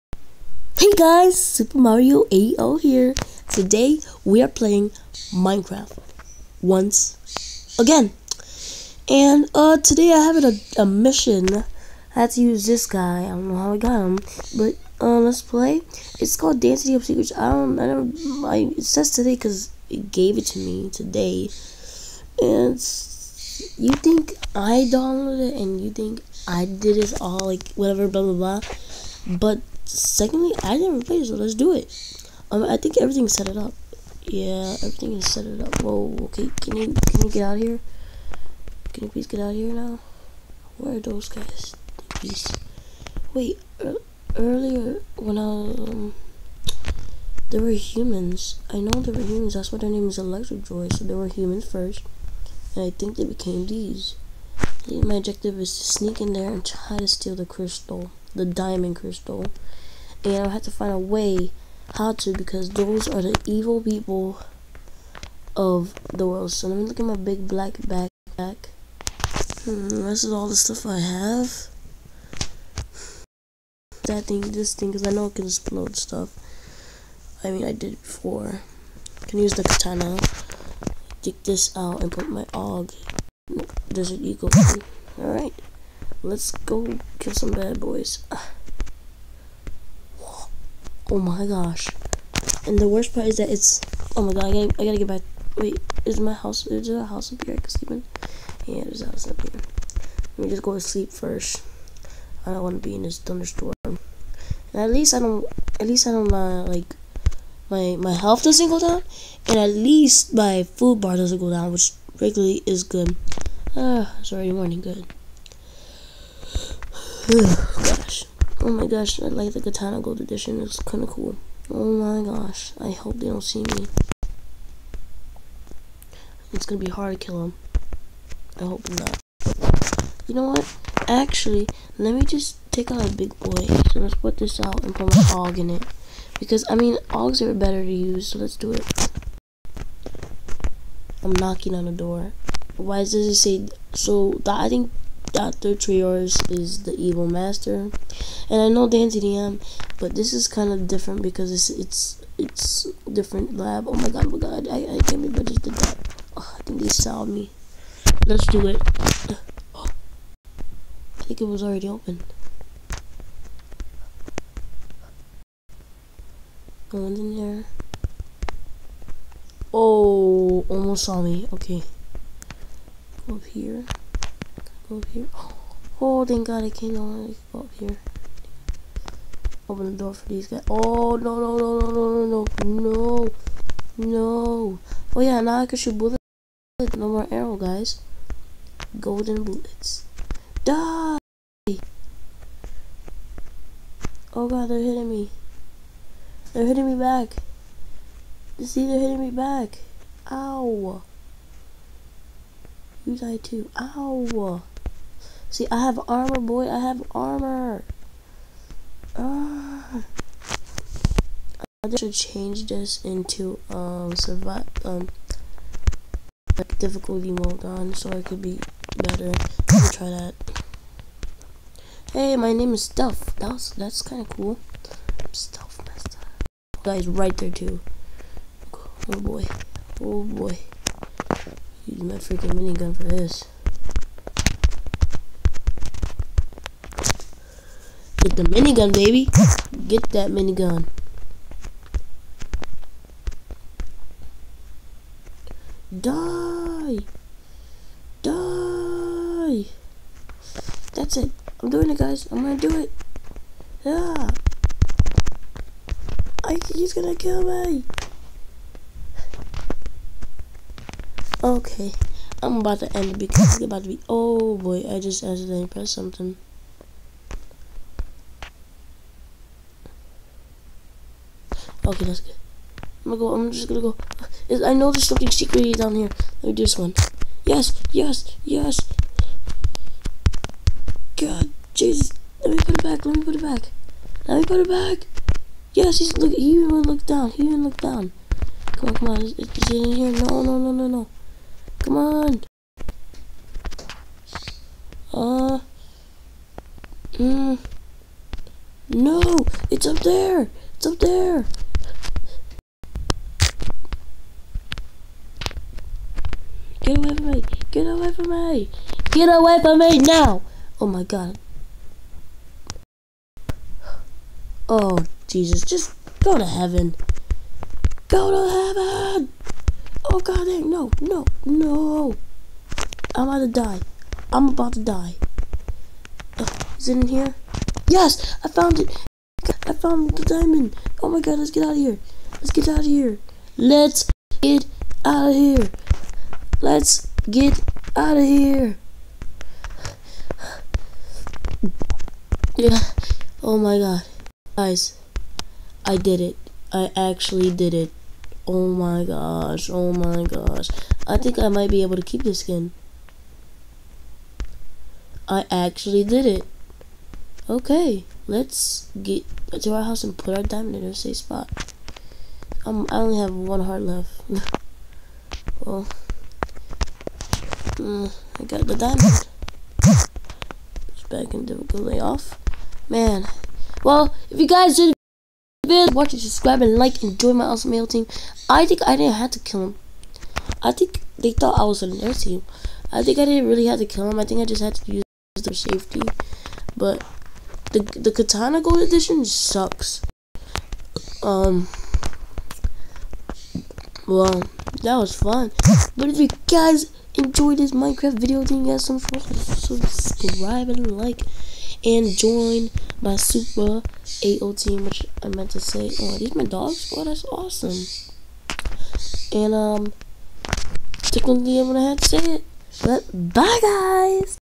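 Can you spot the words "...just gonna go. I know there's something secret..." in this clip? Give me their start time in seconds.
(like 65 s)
273 s.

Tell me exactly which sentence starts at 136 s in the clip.
Because, I mean, AUGs are better to use, so let's do it.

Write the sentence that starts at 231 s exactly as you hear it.
Use my freaking minigun for this.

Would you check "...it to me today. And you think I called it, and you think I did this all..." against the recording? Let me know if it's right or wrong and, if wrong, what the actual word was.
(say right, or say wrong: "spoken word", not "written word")
wrong: "downloaded", not "called".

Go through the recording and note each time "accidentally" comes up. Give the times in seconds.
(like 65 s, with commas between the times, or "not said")
265 s.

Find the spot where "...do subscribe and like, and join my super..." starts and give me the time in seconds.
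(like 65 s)
398 s.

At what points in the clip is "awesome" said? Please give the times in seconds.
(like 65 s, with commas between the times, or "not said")
377 s, 407 s.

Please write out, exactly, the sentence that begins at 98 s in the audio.
Yeah, there's a house up here.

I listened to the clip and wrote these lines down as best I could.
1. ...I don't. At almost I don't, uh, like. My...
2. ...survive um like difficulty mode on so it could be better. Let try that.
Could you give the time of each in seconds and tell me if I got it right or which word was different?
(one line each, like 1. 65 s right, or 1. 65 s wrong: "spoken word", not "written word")
1. 105 s wrong: "least", not "almost"
2. 214 s right.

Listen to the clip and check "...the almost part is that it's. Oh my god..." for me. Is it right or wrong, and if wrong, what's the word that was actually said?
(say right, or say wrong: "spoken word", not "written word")
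wrong: "worst", not "almost".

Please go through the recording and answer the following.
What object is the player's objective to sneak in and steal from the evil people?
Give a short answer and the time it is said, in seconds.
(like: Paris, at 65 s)
the diamond crystal, at 58 s.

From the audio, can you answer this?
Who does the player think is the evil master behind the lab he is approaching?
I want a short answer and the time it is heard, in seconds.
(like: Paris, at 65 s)
Dr. Trayaurus, at 145 s.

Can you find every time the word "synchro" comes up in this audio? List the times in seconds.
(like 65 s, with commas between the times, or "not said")
not said.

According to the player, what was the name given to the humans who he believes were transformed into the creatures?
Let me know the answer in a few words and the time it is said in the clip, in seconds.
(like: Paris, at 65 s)
Electro Joy, at 50 s.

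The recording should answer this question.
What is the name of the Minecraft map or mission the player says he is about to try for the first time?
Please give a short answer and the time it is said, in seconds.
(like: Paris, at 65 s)
Dancing Up Secrets, at 16 s.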